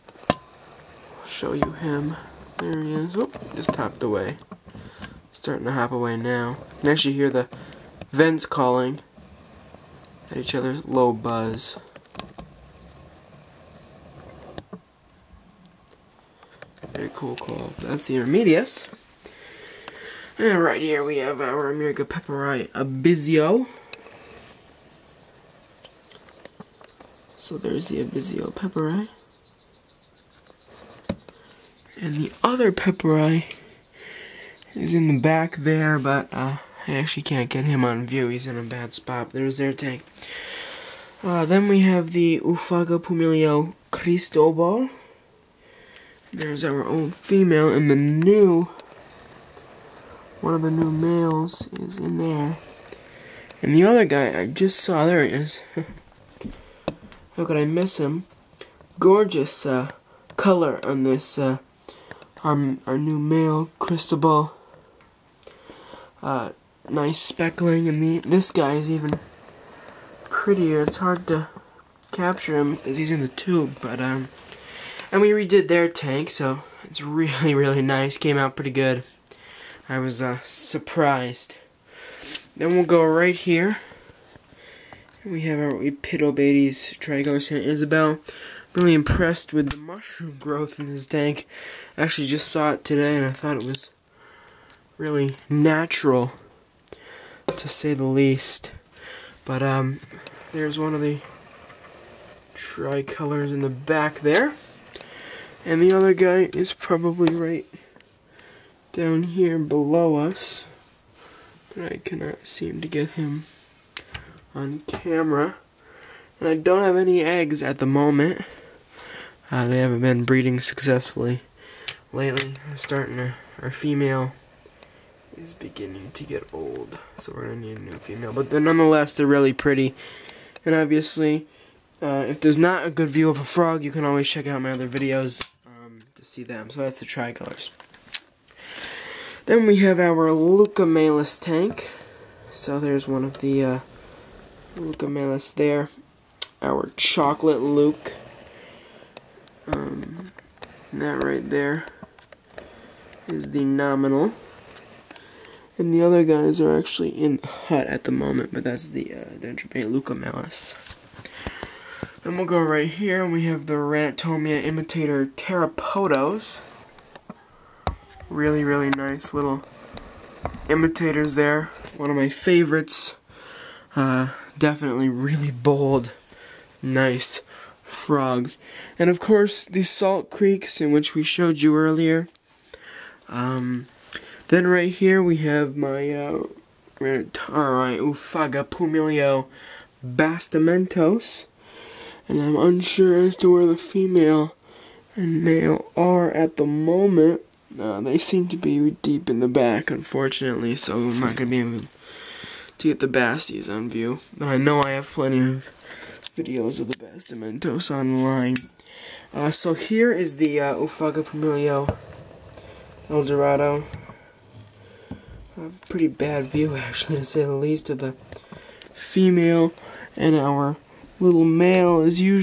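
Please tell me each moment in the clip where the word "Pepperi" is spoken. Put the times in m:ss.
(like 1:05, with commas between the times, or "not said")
0:22, 0:28, 0:32.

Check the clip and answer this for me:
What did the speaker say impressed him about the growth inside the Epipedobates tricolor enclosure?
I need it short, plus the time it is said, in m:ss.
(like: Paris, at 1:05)
Mushroom growth, at 1:29.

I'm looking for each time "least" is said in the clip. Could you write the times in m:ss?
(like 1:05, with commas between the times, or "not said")
1:38, 3:37.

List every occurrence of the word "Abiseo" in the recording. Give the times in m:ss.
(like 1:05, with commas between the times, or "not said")
0:22, 0:28.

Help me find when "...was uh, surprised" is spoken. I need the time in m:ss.
1:19.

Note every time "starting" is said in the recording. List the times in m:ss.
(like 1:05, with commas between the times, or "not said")
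0:05, 2:02.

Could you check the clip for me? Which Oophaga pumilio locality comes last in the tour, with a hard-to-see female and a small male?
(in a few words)
El Dorado.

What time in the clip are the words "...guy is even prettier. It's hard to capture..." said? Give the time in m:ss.
1:08.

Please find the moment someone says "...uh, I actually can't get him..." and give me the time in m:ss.
0:36.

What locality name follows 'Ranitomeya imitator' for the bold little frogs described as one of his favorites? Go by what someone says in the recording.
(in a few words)
Terapodos.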